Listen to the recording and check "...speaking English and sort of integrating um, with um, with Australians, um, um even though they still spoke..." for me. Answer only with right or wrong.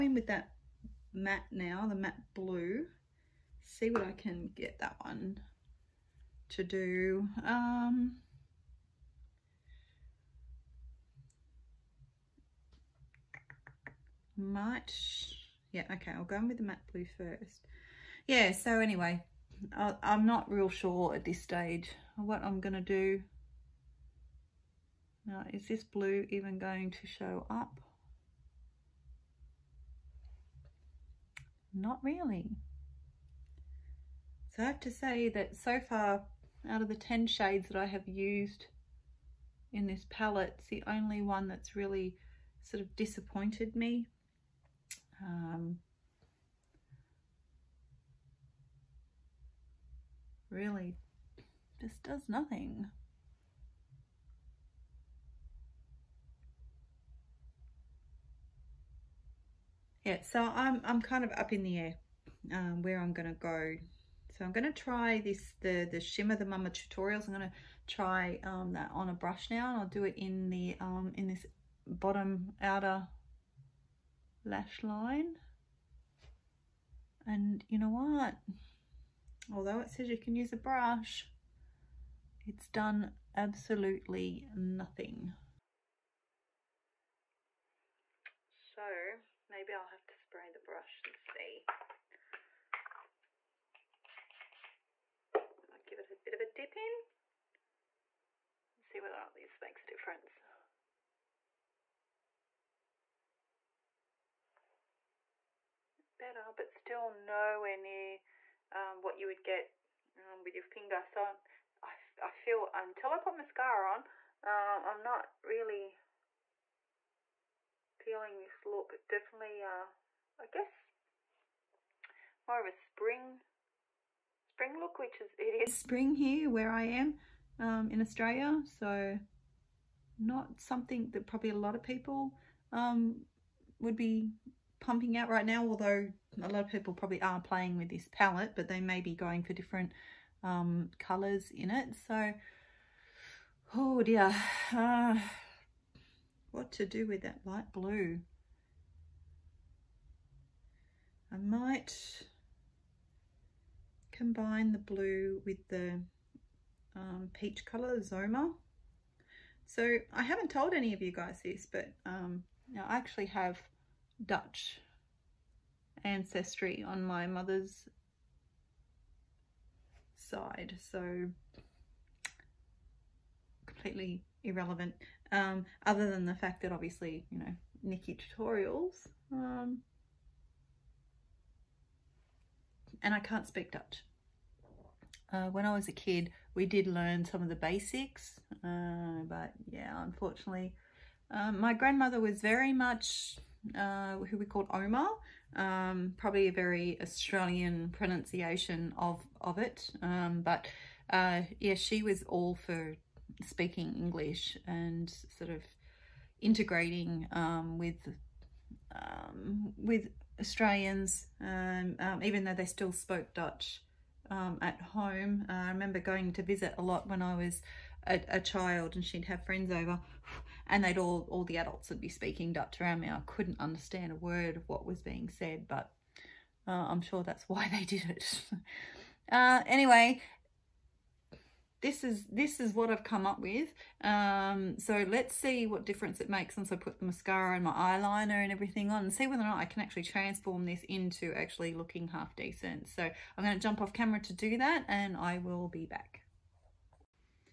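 right.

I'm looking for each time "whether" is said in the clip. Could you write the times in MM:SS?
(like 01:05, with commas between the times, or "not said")
01:38, 03:59.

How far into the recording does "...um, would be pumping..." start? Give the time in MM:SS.
02:12.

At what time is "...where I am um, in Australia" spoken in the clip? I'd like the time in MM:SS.
02:06.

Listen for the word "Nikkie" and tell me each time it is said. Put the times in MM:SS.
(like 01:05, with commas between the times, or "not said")
02:57.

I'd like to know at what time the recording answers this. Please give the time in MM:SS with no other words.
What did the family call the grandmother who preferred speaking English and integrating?
03:14.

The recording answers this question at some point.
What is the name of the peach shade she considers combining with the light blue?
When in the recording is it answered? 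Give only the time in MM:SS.
02:37.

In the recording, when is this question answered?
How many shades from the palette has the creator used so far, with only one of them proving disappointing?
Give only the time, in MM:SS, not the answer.
00:36.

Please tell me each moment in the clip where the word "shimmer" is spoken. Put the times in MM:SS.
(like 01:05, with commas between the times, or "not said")
01:06.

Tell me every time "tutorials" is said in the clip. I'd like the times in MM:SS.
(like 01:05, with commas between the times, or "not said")
01:06, 02:58.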